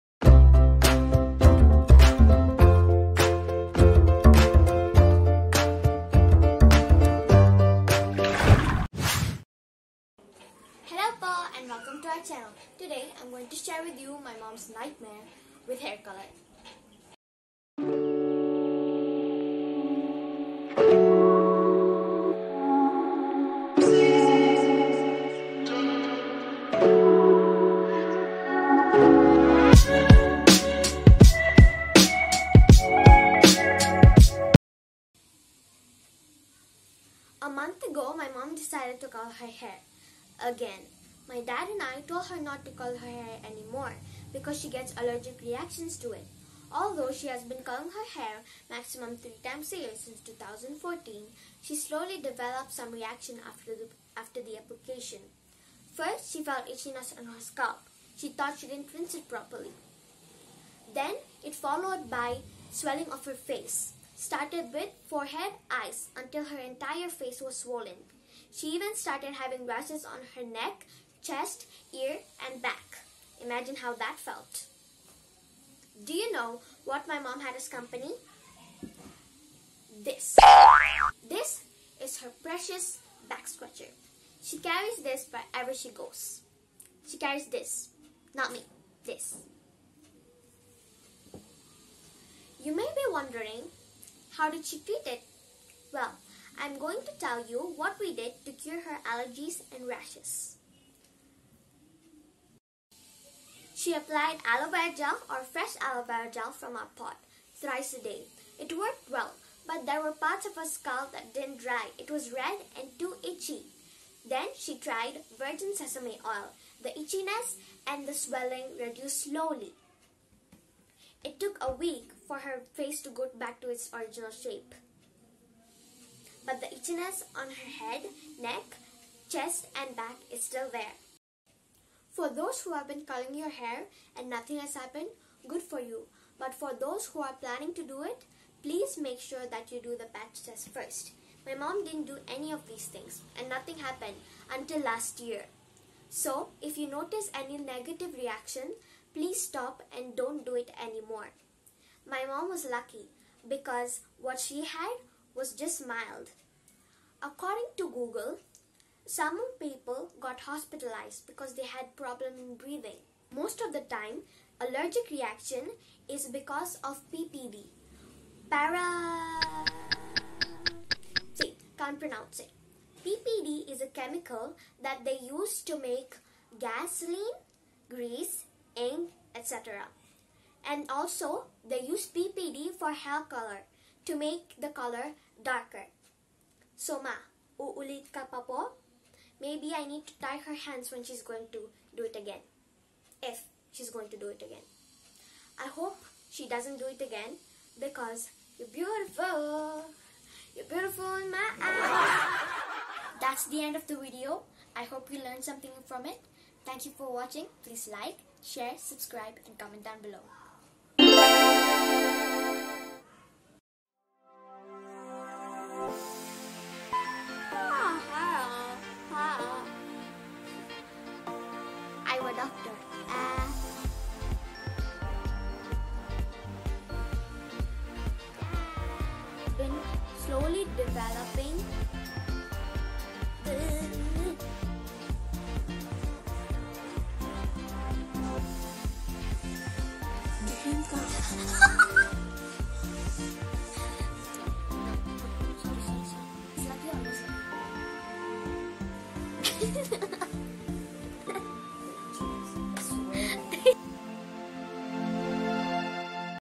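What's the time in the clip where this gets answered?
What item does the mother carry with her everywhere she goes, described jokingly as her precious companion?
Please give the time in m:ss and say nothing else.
1:23.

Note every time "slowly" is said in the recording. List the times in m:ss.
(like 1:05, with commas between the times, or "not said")
0:51, 1:59.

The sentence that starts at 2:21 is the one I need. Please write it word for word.
My mom didn't do any of these things and nothing happened until last year.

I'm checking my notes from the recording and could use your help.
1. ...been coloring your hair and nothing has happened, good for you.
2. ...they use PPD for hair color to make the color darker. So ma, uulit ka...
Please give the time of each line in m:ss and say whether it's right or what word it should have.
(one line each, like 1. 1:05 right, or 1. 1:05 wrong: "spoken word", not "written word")
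1. 2:12 right
2. 3:01 right.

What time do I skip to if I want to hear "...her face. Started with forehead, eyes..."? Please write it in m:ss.
1:03.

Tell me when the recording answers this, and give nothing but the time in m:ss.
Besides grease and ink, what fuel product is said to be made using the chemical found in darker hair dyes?
2:56.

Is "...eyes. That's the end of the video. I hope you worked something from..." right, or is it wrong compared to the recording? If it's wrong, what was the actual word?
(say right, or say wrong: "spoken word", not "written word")
wrong: "learned", not "worked".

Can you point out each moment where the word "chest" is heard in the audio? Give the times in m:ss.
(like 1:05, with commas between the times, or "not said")
1:11, 2:09.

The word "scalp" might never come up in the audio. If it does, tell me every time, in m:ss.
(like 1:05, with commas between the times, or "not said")
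0:57, 1:50.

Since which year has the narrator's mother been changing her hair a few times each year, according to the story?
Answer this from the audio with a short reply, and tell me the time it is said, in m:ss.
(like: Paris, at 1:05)
2014, at 0:50.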